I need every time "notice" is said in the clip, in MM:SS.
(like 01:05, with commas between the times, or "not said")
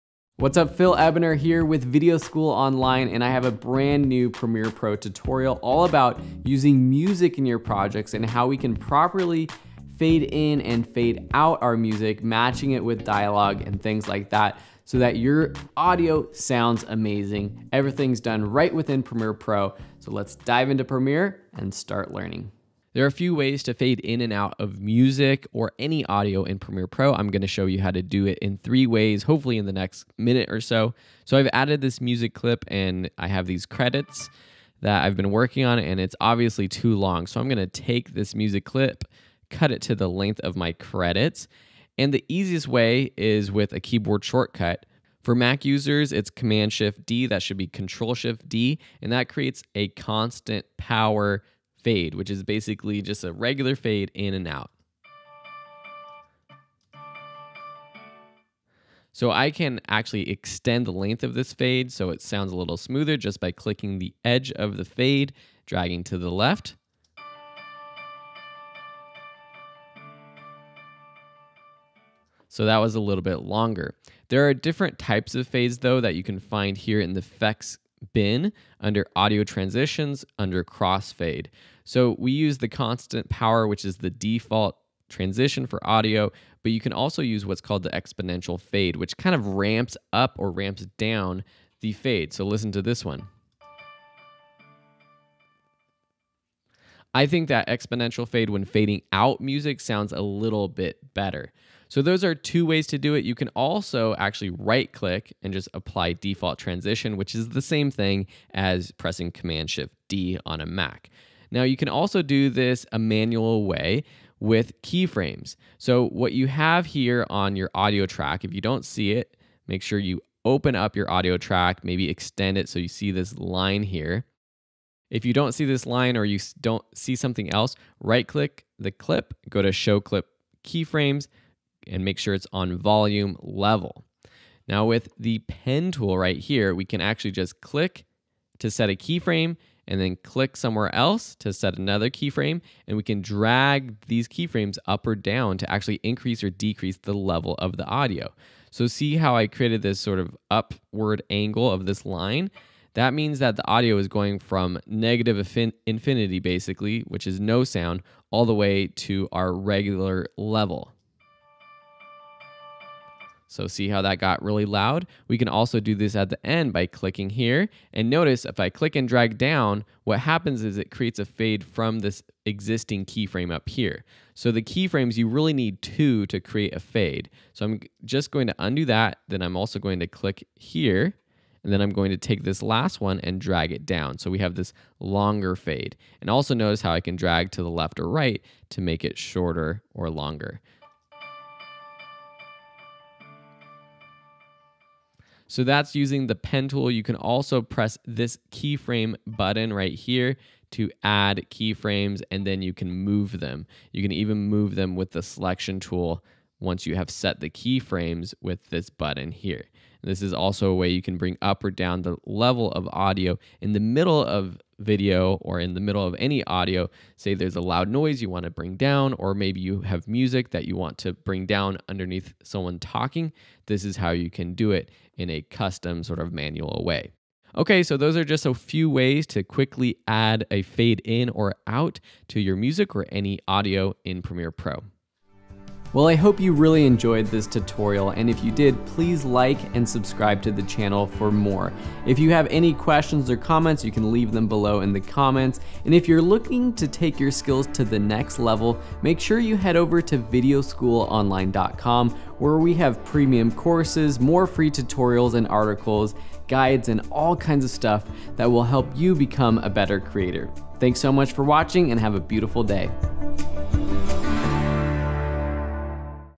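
02:48, 03:06.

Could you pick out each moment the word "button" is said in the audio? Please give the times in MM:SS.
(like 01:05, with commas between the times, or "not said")
03:19, 03:28.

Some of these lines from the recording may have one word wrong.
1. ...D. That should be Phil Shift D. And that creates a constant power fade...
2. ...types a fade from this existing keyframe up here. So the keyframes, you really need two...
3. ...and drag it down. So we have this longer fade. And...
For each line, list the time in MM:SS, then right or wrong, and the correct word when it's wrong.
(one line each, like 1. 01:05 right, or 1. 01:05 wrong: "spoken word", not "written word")
1. 00:47 wrong: "Control", not "Phil"
2. 02:50 wrong: "creates", not "types"
3. 03:03 right.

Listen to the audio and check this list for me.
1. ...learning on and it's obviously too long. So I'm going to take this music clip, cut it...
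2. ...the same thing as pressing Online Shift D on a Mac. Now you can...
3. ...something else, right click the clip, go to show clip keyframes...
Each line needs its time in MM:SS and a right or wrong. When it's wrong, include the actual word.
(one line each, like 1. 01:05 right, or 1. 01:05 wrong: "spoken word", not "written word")
1. 00:35 wrong: "working", not "learning"
2. 01:47 wrong: "Command", not "Online"
3. 02:07 right.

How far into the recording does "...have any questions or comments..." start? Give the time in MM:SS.
04:02.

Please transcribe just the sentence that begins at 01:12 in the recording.
So that was a little bit longer.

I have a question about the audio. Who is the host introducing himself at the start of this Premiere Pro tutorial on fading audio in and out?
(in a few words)
Phil Ebiner.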